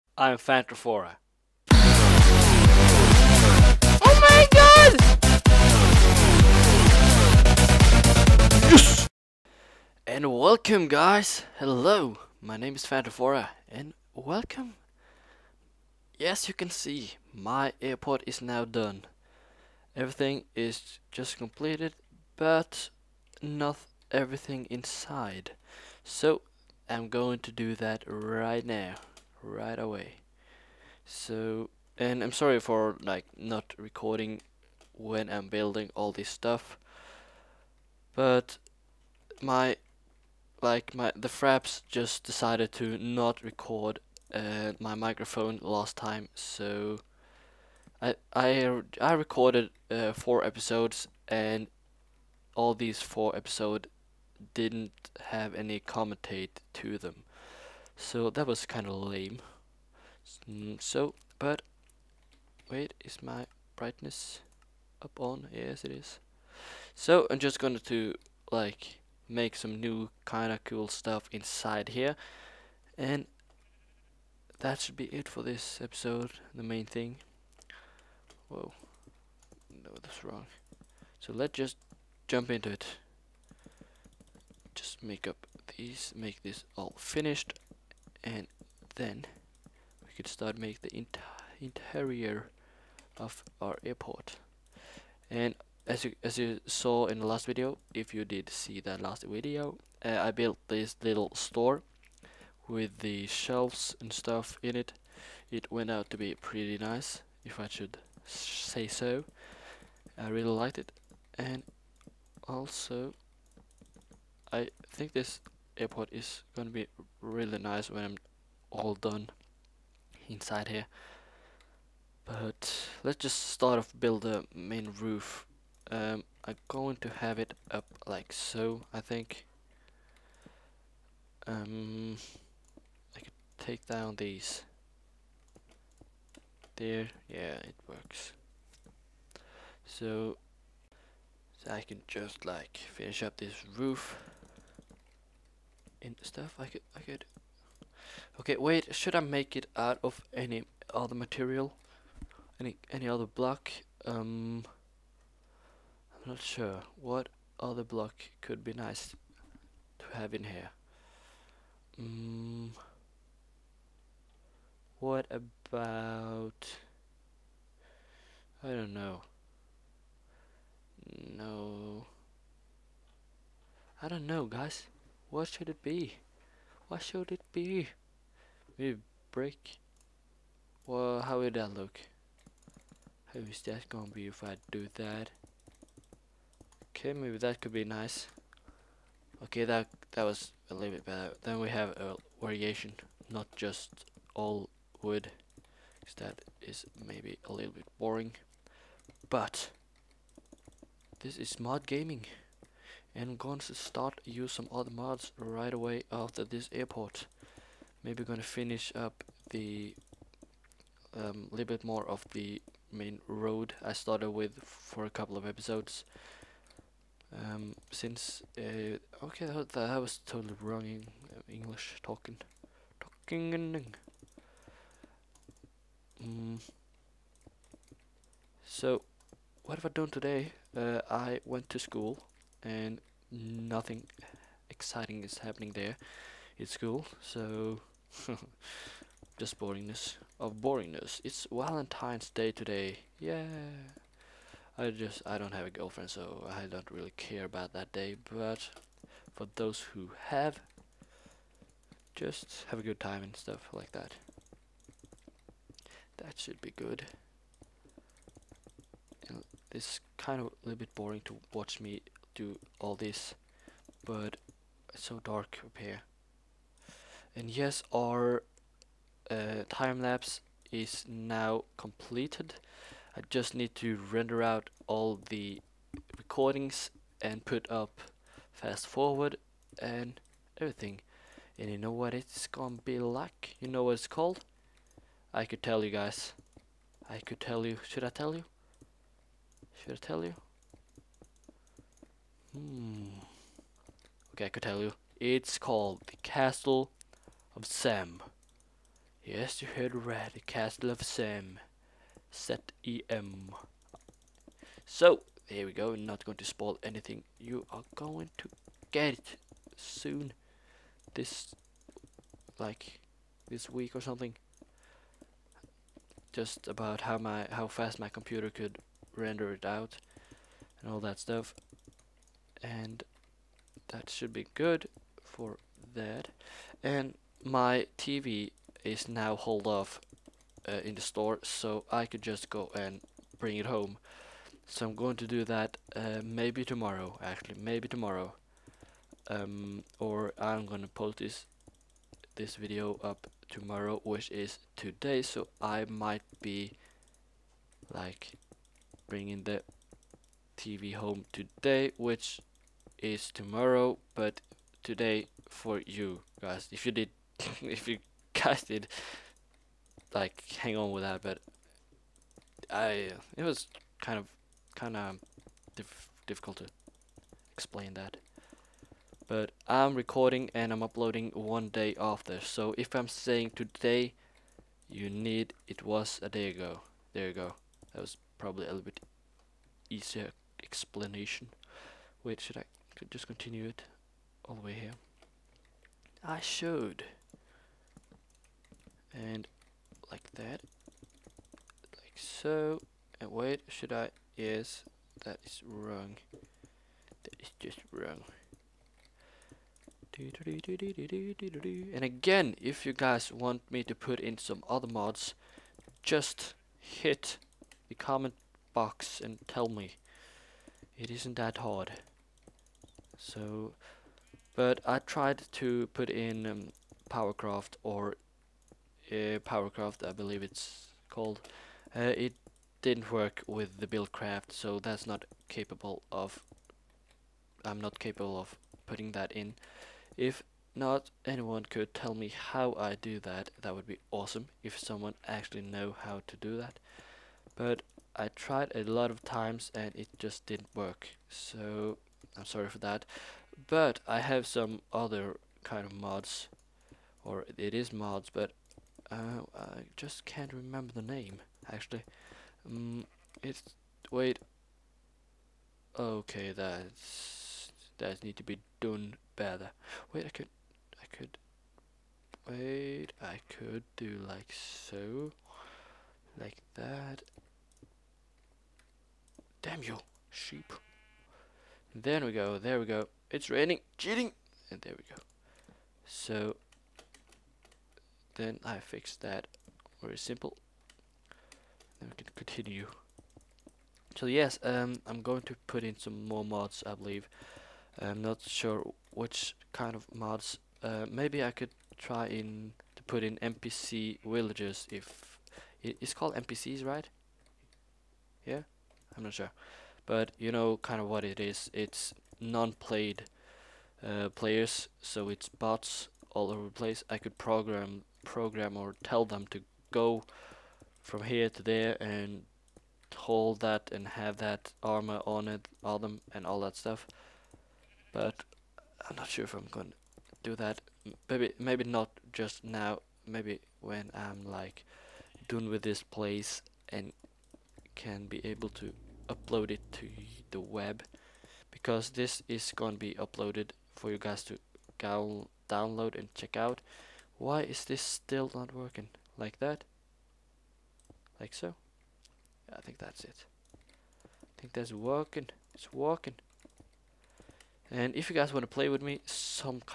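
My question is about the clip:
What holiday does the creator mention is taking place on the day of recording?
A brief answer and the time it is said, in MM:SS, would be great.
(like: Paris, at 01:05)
Valentine's Day, at 04:01.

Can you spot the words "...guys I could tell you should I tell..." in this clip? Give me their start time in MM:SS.
04:45.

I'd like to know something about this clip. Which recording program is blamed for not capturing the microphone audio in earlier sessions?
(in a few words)
Fraps.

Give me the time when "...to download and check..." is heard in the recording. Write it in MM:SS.
08:54.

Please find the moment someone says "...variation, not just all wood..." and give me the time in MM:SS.
03:12.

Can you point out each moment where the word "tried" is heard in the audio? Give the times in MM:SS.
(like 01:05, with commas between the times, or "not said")
06:54, 07:18.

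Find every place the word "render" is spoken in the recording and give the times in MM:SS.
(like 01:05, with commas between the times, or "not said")
04:34, 05:19.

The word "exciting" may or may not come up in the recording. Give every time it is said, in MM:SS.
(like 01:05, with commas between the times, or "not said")
03:54.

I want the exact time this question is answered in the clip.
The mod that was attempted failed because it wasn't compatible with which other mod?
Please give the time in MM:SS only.
07:03.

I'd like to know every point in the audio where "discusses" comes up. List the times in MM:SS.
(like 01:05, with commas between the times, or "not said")
not said.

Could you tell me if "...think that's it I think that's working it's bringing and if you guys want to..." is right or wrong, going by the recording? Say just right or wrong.
wrong.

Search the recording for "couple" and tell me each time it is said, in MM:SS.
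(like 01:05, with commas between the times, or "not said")
03:35.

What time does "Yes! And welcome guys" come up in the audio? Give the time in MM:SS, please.
00:08.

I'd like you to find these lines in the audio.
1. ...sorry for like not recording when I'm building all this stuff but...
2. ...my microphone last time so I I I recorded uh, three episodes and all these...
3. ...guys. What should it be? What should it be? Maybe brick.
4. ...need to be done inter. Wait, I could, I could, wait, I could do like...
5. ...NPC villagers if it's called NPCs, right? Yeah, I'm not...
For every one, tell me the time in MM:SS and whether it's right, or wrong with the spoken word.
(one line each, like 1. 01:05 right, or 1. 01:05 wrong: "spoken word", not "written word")
1. 00:32 right
2. 00:44 wrong: "four", not "three"
3. 02:54 right
4. 07:38 wrong: "better", not "inter"
5. 08:13 right.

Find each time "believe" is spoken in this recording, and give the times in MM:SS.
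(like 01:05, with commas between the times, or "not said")
07:00, 08:06.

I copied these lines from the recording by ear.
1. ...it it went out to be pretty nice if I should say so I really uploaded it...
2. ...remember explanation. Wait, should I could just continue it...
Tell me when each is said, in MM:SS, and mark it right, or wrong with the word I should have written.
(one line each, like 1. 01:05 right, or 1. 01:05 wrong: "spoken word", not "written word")
1. 01:44 wrong: "liked", not "uploaded"
2. 06:19 wrong: "easier", not "remember".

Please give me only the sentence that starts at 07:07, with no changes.
I'm not capable of putting that in.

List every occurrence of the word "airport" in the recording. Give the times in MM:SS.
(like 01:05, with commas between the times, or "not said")
00:17, 01:33, 01:55, 03:26.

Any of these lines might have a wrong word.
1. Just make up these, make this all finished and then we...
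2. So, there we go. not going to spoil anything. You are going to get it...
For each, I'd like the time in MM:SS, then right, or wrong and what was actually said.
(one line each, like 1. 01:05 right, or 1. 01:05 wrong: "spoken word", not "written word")
1. 01:24 right
2. 05:04 right.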